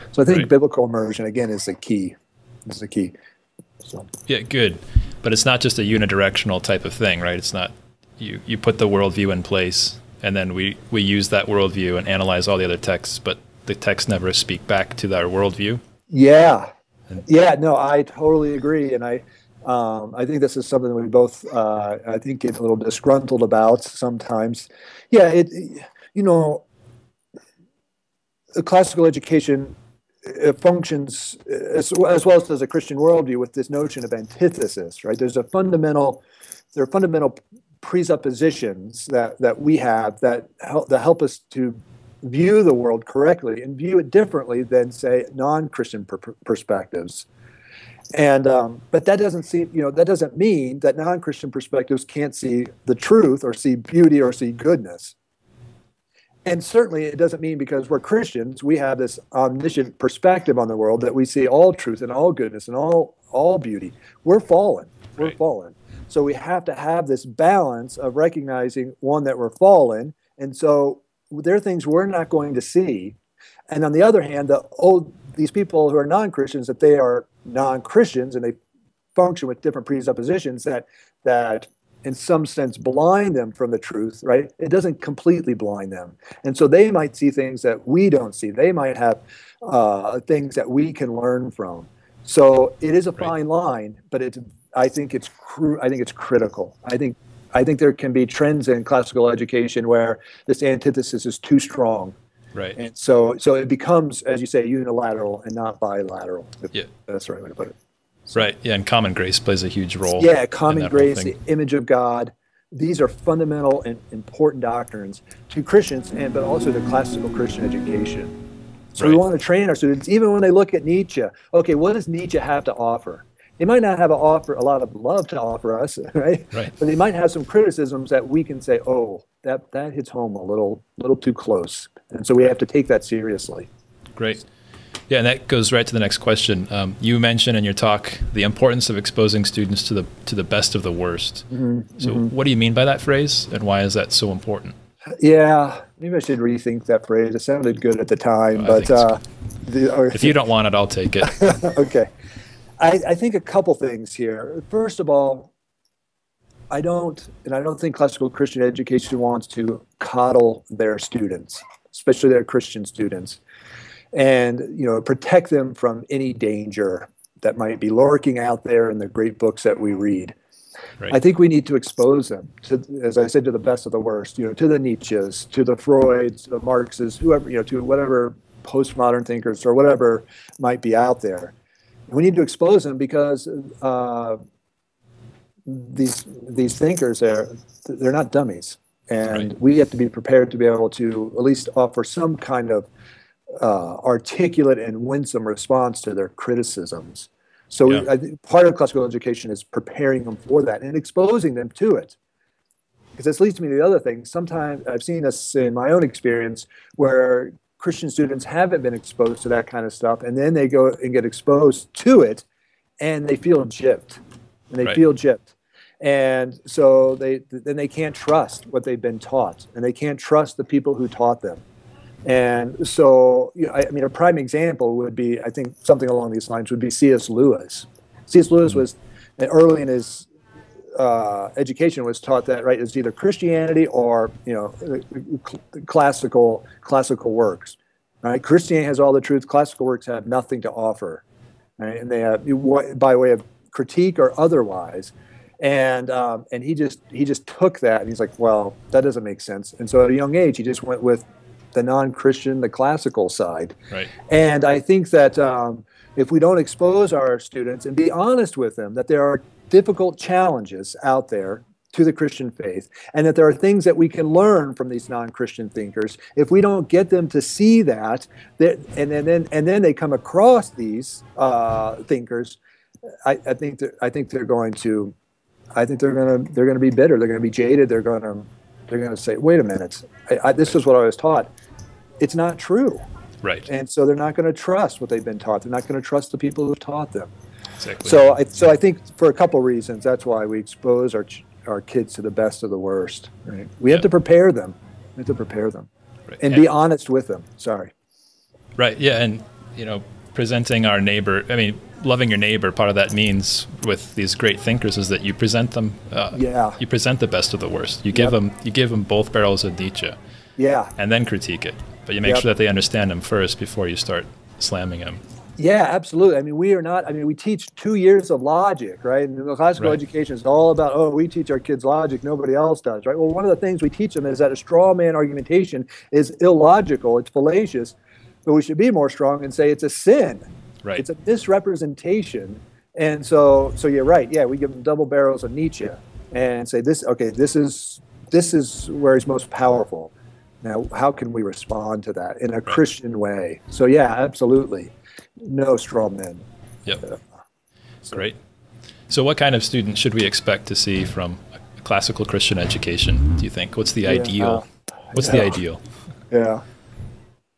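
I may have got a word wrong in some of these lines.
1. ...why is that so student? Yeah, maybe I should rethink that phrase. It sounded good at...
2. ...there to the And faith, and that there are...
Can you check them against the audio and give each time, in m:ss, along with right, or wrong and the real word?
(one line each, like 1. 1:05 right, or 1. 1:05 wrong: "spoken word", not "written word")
1. 2:23 wrong: "important", not "student"
2. 4:21 wrong: "Christian", not "And".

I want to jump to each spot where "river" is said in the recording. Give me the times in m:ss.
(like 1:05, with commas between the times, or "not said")
not said.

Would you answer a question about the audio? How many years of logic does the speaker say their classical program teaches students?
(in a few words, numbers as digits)
2.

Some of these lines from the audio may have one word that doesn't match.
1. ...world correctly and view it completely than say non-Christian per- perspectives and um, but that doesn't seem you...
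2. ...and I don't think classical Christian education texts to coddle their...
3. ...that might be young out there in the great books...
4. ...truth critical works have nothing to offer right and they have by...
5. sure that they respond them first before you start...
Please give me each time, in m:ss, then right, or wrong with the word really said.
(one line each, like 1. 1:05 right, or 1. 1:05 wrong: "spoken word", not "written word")
1. 0:42 wrong: "differently", not "completely"
2. 2:37 wrong: "wants", not "texts"
3. 2:47 wrong: "lurking", not "young"
4. 3:59 wrong: "classical", not "critical"
5. 5:12 wrong: "understand", not "respond".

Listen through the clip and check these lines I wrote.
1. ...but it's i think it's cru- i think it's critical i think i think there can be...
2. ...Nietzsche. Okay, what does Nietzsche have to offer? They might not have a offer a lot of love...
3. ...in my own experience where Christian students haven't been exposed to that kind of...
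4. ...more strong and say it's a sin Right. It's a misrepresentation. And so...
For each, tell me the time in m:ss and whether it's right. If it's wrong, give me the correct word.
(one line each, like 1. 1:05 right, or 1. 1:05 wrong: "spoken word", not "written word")
1. 1:34 right
2. 2:00 right
3. 3:25 right
4. 5:28 right.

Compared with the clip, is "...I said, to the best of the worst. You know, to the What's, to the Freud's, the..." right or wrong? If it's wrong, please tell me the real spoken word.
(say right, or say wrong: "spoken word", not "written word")
wrong: "Nietzsche", not "What".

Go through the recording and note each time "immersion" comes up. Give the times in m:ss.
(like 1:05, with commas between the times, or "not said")
0:00.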